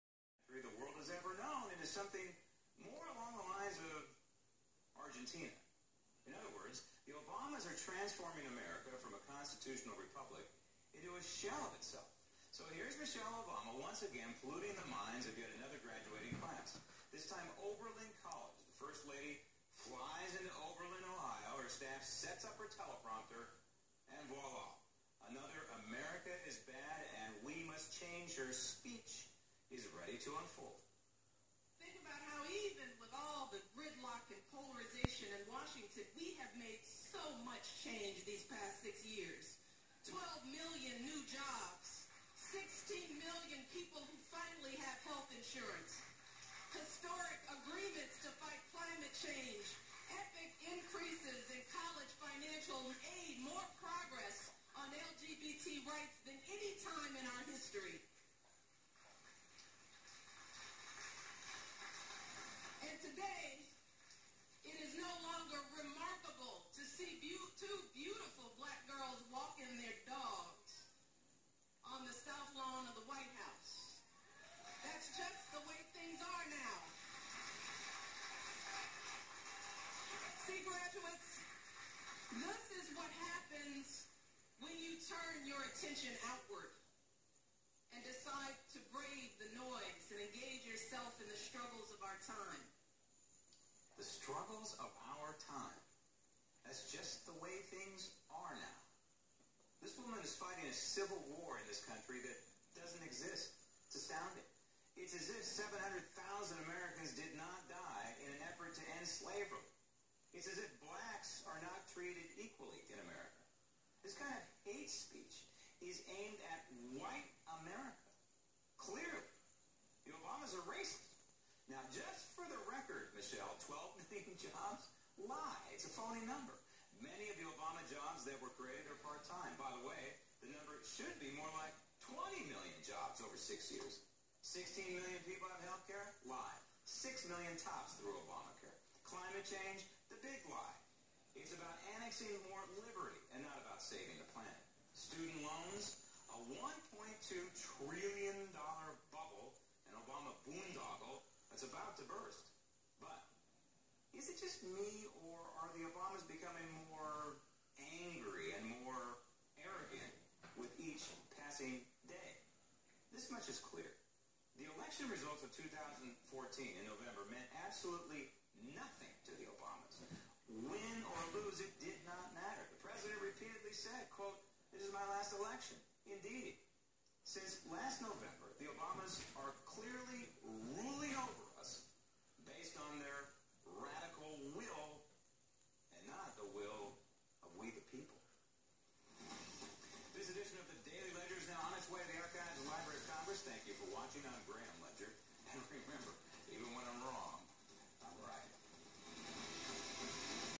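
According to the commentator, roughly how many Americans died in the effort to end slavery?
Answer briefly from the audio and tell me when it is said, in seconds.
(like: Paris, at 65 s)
700,000, at 105 s.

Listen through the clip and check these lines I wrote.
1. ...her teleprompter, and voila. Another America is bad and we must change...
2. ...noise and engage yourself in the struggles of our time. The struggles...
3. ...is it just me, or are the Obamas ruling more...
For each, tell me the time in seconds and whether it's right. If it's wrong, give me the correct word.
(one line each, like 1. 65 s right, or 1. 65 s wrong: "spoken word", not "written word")
1. 22 s right
2. 89 s right
3. 154 s wrong: "becoming", not "ruling".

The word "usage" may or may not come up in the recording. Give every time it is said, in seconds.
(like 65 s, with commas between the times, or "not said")
not said.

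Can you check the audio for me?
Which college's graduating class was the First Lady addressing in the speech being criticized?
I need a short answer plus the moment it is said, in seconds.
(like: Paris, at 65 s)
Oberlin College, at 17 s.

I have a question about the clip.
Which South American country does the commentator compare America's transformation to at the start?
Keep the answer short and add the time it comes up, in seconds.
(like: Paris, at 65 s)
Argentina, at 5 s.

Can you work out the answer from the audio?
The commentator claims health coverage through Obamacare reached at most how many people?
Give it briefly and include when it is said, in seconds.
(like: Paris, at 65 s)
6 million, at 136 s.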